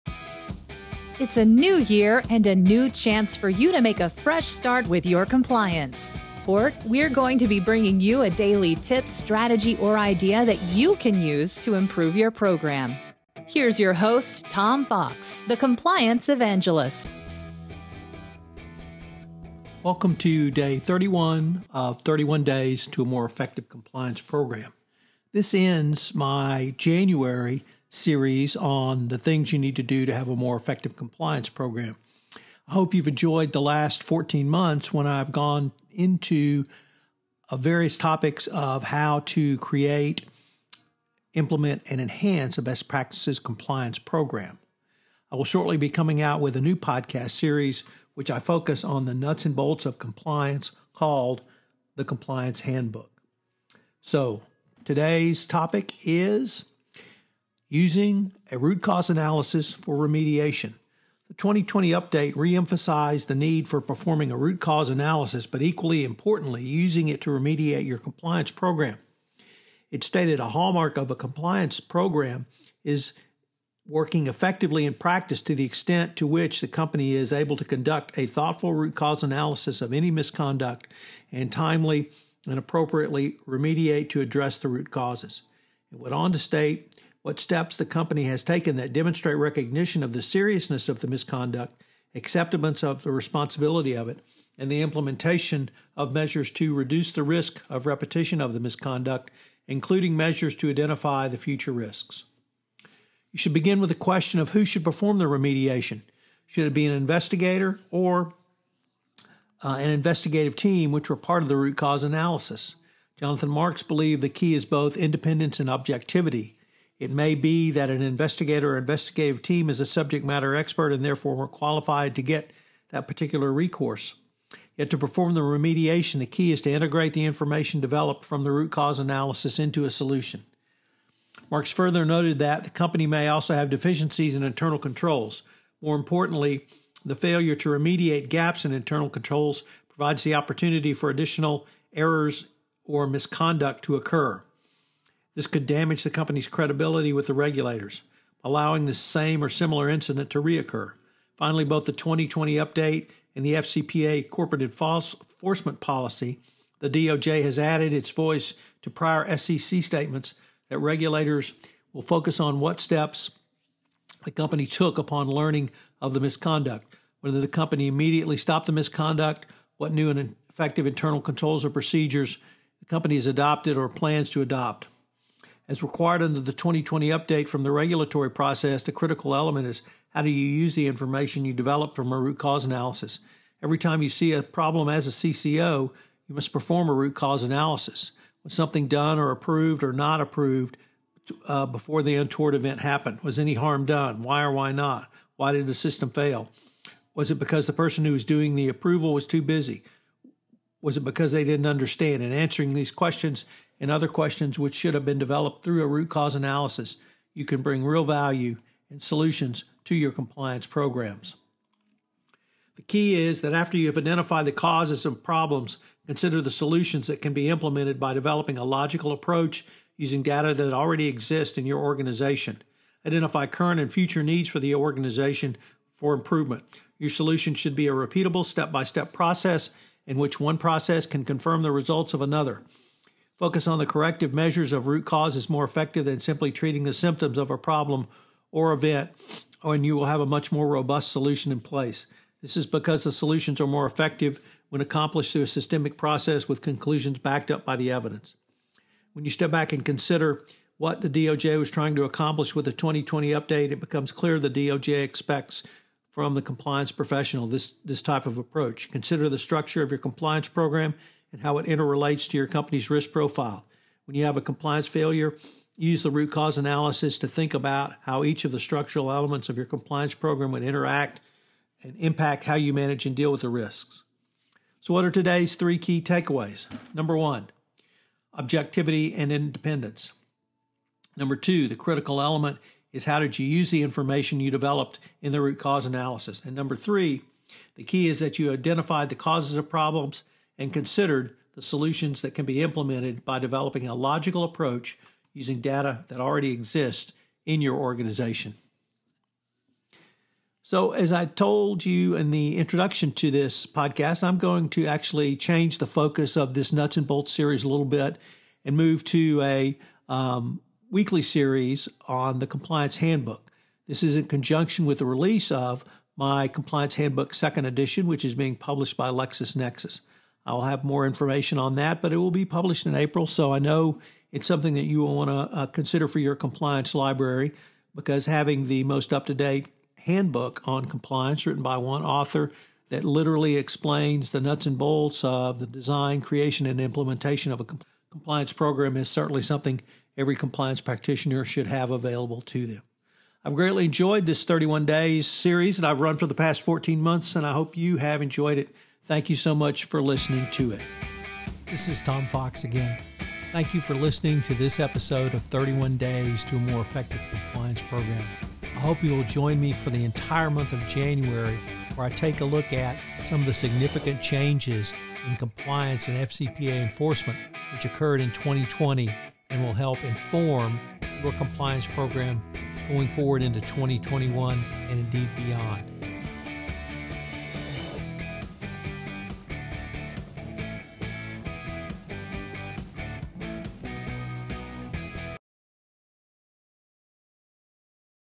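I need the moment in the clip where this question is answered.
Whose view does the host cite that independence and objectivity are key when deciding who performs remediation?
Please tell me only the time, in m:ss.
1:53.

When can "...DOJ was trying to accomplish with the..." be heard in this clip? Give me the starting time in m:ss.
4:11.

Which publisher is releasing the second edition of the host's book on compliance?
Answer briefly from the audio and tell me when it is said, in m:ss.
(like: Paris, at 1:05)
LexisNexis, at 5:19.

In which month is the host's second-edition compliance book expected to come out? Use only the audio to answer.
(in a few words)
April.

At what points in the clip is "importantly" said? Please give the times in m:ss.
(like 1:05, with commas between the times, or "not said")
1:06, 2:15.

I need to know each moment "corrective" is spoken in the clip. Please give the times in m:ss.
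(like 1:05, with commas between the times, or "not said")
3:53.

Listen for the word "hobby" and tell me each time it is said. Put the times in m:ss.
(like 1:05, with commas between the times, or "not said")
not said.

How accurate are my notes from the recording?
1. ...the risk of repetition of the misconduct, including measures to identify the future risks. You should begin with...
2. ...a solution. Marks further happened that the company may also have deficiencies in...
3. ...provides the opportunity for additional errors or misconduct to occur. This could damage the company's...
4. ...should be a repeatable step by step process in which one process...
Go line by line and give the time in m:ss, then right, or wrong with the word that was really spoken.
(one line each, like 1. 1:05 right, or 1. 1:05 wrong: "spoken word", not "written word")
1. 1:37 right
2. 2:09 wrong: "noted", not "happened"
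3. 2:19 right
4. 3:47 right.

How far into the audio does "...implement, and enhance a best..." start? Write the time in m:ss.
0:41.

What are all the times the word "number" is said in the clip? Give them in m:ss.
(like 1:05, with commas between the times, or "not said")
4:36, 4:41, 4:46.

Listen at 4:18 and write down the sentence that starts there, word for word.
Consider the structure of your compliance program and how it interrelates to your company's risk profile.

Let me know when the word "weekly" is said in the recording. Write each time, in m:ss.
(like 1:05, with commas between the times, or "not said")
5:10.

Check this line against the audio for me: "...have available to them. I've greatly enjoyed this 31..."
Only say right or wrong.
right.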